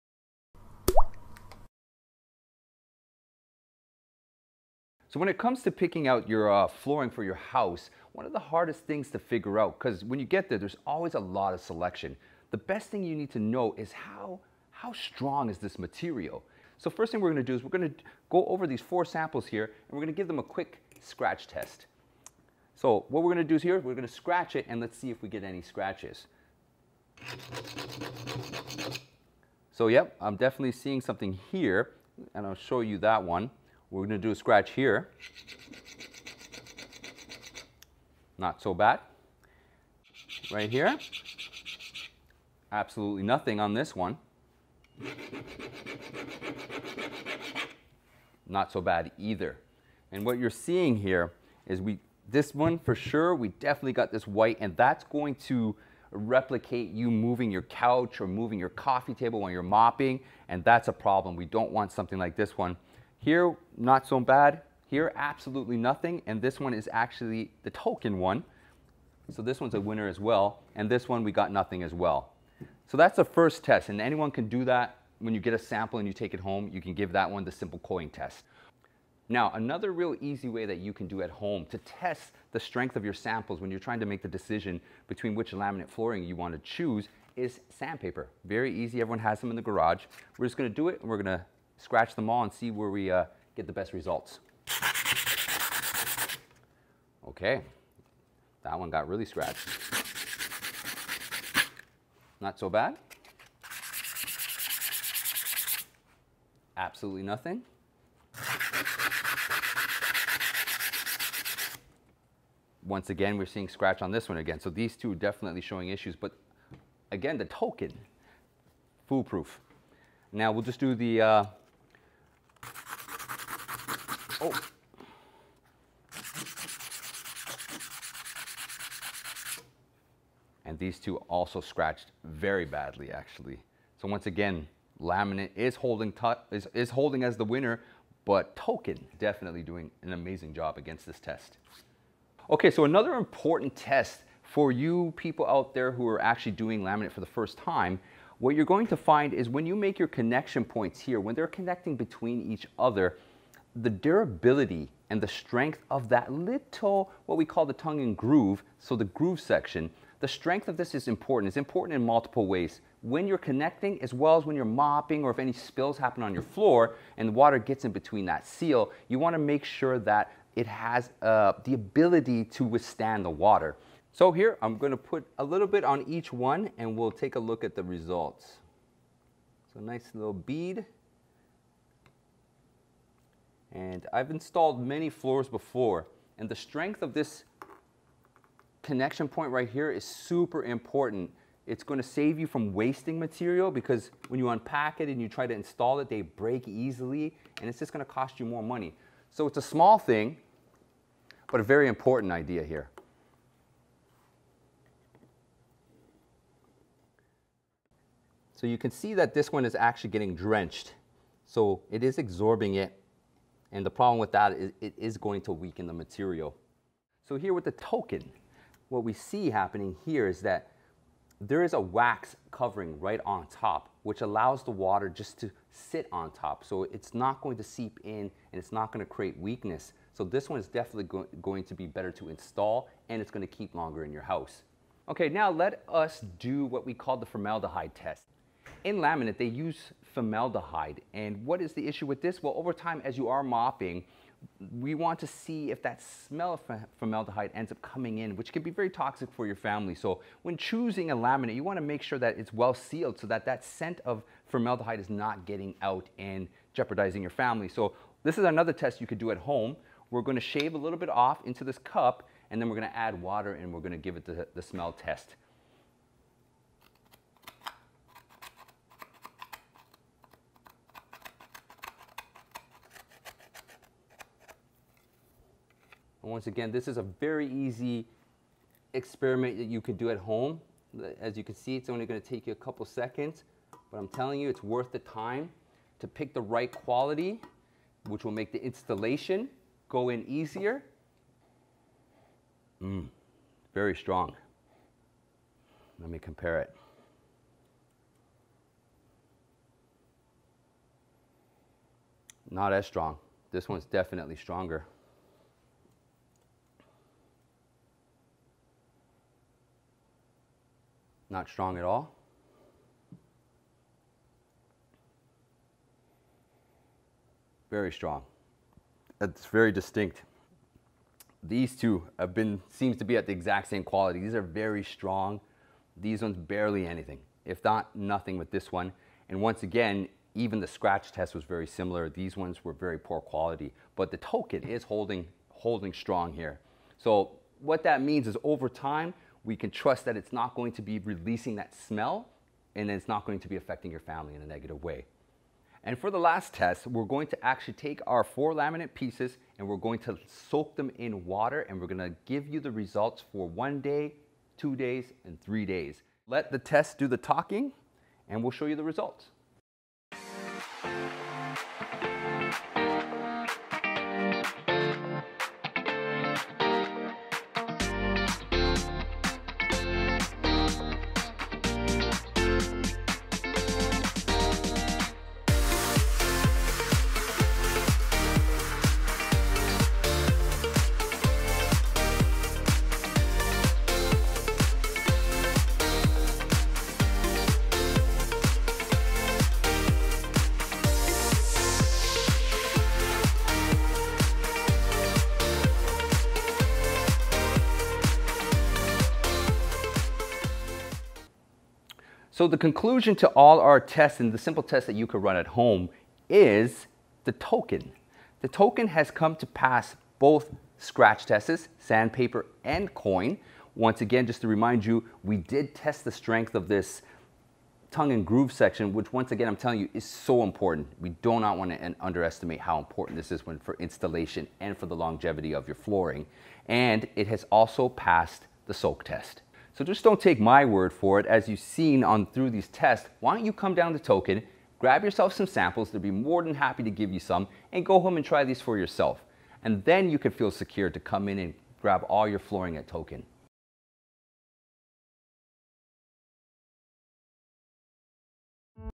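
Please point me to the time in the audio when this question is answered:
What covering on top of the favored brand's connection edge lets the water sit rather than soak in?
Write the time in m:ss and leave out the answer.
3:41.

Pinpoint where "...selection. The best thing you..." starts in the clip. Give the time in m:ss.
0:11.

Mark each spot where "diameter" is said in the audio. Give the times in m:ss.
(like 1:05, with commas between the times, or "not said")
not said.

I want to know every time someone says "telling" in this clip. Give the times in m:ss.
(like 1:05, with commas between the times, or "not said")
4:44, 6:59.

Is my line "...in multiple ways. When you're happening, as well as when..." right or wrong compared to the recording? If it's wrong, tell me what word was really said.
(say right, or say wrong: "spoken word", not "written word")
wrong: "connecting", not "happening".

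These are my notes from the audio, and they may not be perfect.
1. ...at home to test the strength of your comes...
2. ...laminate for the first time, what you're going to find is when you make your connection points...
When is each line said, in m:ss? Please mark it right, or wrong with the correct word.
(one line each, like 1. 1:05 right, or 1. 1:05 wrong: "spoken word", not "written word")
1. 1:21 wrong: "samples", not "comes"
2. 2:26 right.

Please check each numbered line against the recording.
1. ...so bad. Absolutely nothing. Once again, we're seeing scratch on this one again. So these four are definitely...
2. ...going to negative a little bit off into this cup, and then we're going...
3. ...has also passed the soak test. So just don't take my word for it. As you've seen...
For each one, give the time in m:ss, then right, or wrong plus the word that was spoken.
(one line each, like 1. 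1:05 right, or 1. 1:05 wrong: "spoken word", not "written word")
1. 1:42 wrong: "two", not "four"
2. 4:20 wrong: "shave", not "negative"
3. 7:07 right.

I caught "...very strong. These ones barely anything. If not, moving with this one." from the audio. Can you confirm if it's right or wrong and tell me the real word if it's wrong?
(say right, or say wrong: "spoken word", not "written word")
wrong: "nothing", not "moving".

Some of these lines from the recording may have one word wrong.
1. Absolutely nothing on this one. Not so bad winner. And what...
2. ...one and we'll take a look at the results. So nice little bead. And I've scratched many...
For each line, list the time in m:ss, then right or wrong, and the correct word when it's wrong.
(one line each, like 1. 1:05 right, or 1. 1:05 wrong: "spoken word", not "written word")
1. 0:42 wrong: "either", not "winner"
2. 2:56 wrong: "installed", not "scratched".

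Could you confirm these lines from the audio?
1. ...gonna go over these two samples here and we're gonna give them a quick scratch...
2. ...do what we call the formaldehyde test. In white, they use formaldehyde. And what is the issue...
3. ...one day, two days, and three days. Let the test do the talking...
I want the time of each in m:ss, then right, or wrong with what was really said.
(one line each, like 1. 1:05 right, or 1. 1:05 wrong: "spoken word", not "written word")
1. 0:17 wrong: "four", not "two"
2. 3:56 wrong: "laminate", not "white"
3. 5:53 right.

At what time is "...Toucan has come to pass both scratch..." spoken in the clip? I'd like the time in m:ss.
6:48.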